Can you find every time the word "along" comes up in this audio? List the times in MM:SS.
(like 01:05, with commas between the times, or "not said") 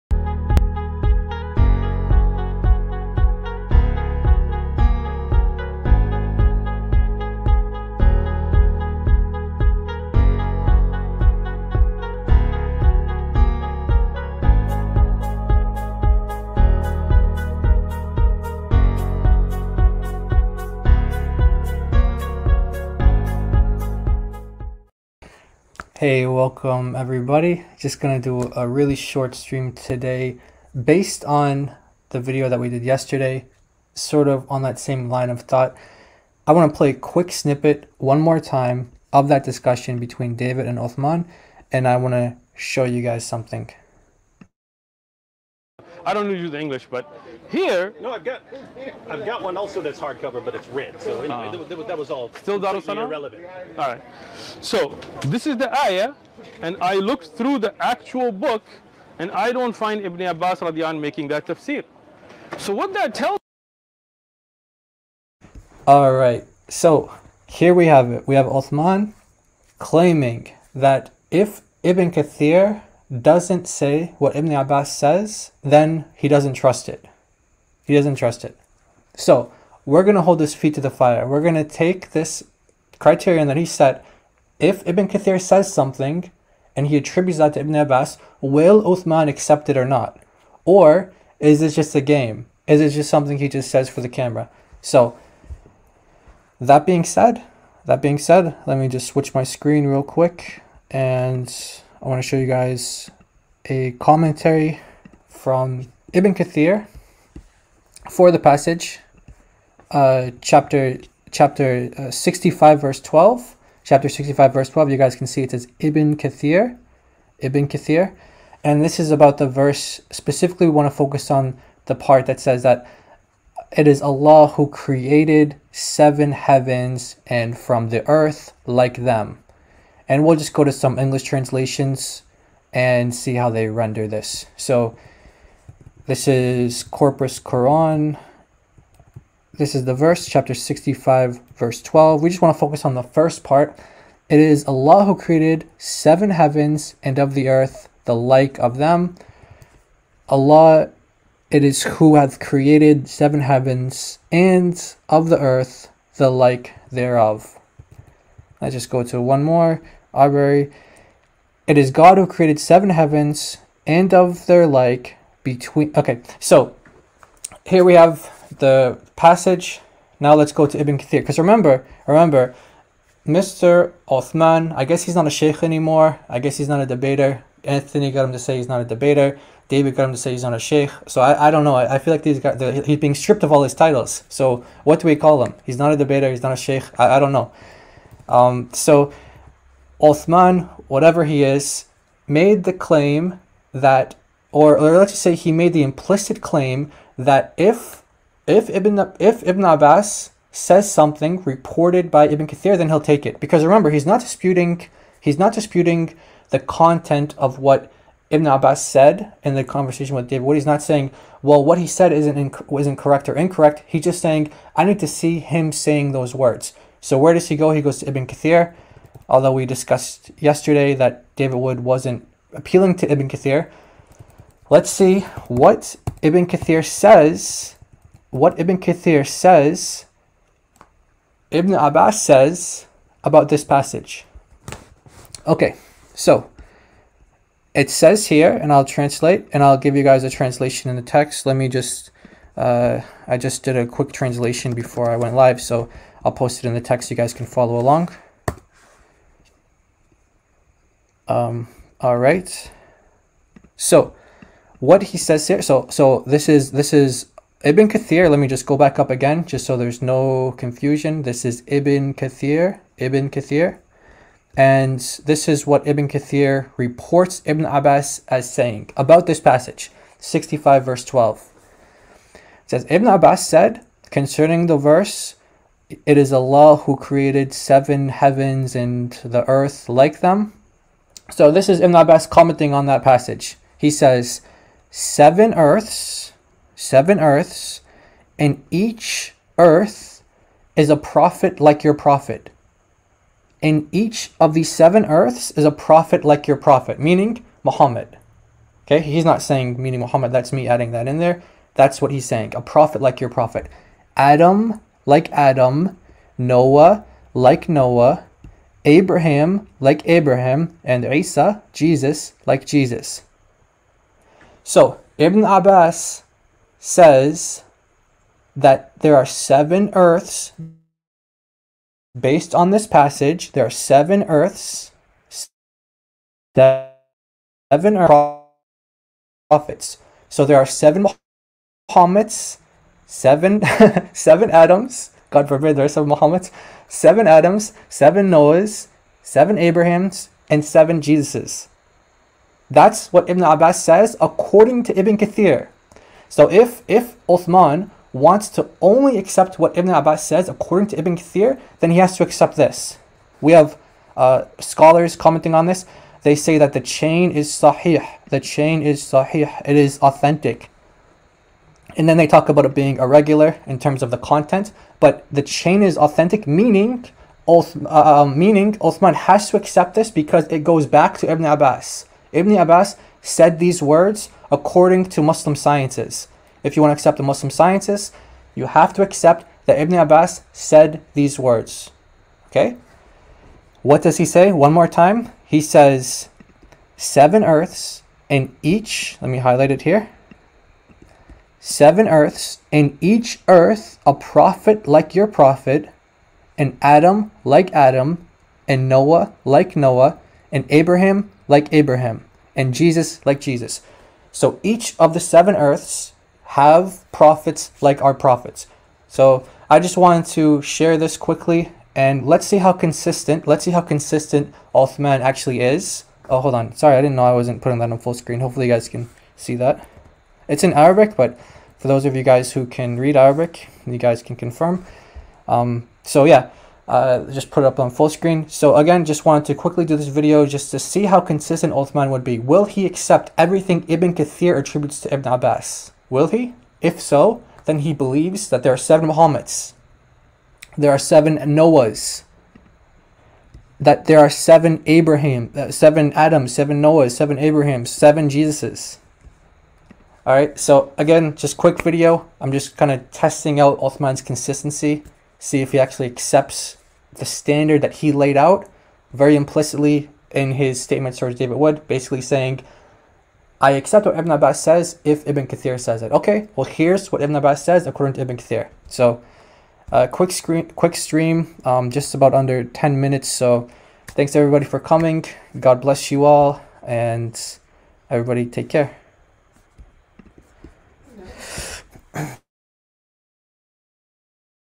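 04:07.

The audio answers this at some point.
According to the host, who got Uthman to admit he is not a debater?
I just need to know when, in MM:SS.
02:57.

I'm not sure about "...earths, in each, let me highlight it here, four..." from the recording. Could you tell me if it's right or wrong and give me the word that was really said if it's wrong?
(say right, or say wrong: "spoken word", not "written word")
wrong: "seven", not "four".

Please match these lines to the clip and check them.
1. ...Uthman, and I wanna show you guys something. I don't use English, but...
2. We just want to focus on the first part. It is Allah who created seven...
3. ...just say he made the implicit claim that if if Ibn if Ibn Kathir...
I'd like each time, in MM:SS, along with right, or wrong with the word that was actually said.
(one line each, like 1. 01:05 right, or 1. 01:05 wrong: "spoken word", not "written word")
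1. 00:40 right
2. 02:22 right
3. 03:15 wrong: "Abbas", not "Kathir".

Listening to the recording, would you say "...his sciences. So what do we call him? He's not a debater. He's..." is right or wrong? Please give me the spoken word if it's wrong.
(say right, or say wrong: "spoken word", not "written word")
wrong: "titles", not "sciences".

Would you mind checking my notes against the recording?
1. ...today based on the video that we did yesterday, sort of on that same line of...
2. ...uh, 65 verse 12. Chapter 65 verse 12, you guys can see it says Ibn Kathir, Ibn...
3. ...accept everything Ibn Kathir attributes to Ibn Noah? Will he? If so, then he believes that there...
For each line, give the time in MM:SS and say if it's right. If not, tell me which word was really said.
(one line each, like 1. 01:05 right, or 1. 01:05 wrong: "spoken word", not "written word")
1. 00:29 right
2. 01:51 right
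3. 07:12 wrong: "Abbas", not "Noah".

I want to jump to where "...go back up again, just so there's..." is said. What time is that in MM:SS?
04:18.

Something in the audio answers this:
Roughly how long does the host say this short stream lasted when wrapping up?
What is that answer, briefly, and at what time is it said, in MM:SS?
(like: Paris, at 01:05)
under 10 minutes, at 07:52.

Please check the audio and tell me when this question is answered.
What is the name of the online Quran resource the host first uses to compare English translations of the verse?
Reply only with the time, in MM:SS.
02:16.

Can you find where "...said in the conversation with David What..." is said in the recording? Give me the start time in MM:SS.
03:28.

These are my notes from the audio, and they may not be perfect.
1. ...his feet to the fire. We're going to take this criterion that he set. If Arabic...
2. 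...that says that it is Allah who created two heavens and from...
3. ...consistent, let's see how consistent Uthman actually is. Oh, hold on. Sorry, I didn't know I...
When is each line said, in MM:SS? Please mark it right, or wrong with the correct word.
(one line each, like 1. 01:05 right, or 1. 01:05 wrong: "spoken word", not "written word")
1. 01:20 wrong: "Ibn", not "Arabic"
2. 02:02 wrong: "seven", not "two"
3. 06:52 right.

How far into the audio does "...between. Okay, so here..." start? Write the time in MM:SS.
02:45.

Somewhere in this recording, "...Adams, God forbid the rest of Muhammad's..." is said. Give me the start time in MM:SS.
05:34.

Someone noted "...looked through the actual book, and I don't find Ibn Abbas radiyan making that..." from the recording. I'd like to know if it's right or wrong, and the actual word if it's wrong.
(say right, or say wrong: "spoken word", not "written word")
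right.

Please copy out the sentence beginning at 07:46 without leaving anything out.
Okay, well, here's what Ibn Abbas says according to Ibn Kathir.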